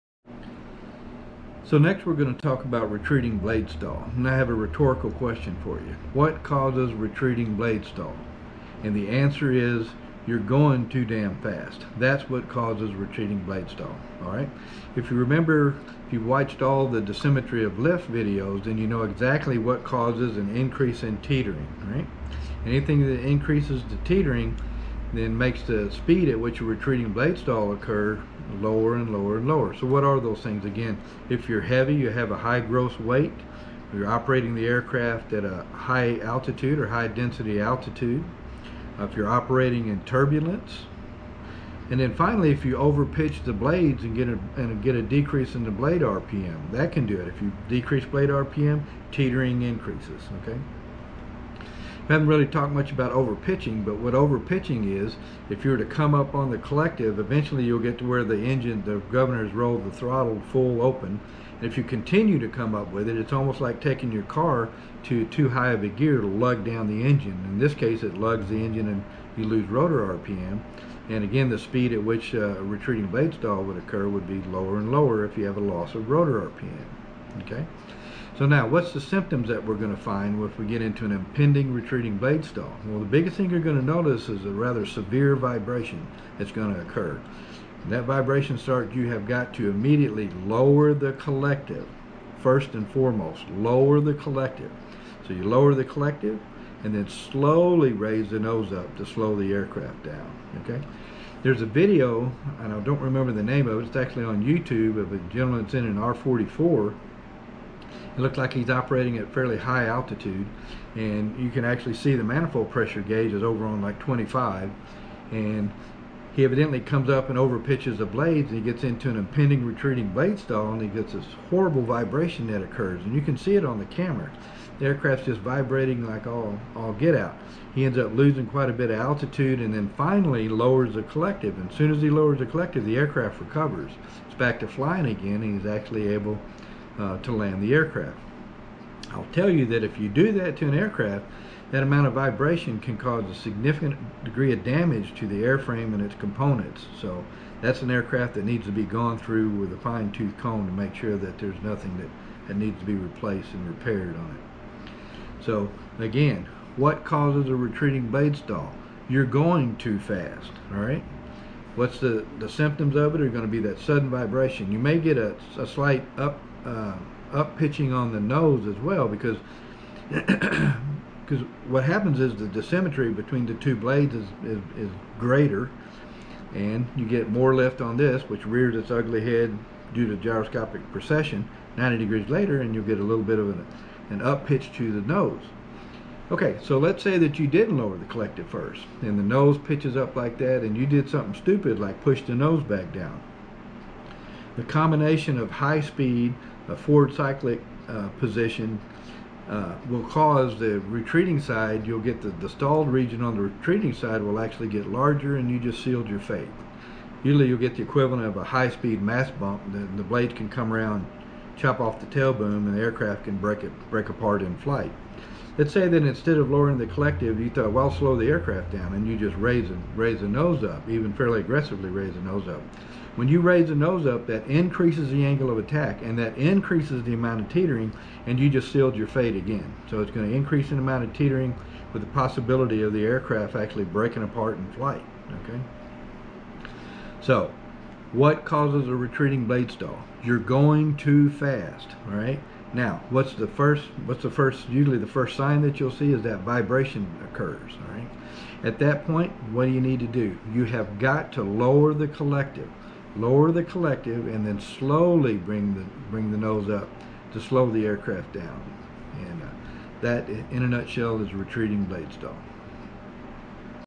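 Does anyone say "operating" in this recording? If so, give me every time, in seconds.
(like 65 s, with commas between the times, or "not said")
34 s, 39 s, 108 s.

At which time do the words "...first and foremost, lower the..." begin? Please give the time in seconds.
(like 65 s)
92 s.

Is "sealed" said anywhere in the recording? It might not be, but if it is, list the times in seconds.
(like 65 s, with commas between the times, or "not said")
205 s, 228 s.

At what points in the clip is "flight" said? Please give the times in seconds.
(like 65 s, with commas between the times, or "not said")
214 s, 234 s.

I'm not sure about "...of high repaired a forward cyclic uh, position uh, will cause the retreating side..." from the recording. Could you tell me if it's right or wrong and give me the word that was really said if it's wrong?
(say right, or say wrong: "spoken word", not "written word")
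wrong: "speed", not "repaired".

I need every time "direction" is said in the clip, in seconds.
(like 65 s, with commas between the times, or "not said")
not said.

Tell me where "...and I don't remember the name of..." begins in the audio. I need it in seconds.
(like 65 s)
102 s.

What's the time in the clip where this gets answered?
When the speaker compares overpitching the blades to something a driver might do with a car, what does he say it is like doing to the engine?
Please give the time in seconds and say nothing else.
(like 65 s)
66 s.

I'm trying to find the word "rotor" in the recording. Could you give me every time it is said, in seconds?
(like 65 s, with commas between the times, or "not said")
69 s, 76 s.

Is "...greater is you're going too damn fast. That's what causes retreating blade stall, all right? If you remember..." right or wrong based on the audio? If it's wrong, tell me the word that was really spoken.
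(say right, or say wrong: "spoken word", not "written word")
wrong: "answer", not "greater".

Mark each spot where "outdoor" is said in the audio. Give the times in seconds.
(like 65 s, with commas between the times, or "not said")
not said.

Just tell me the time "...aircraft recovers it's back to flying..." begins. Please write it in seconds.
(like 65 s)
132 s.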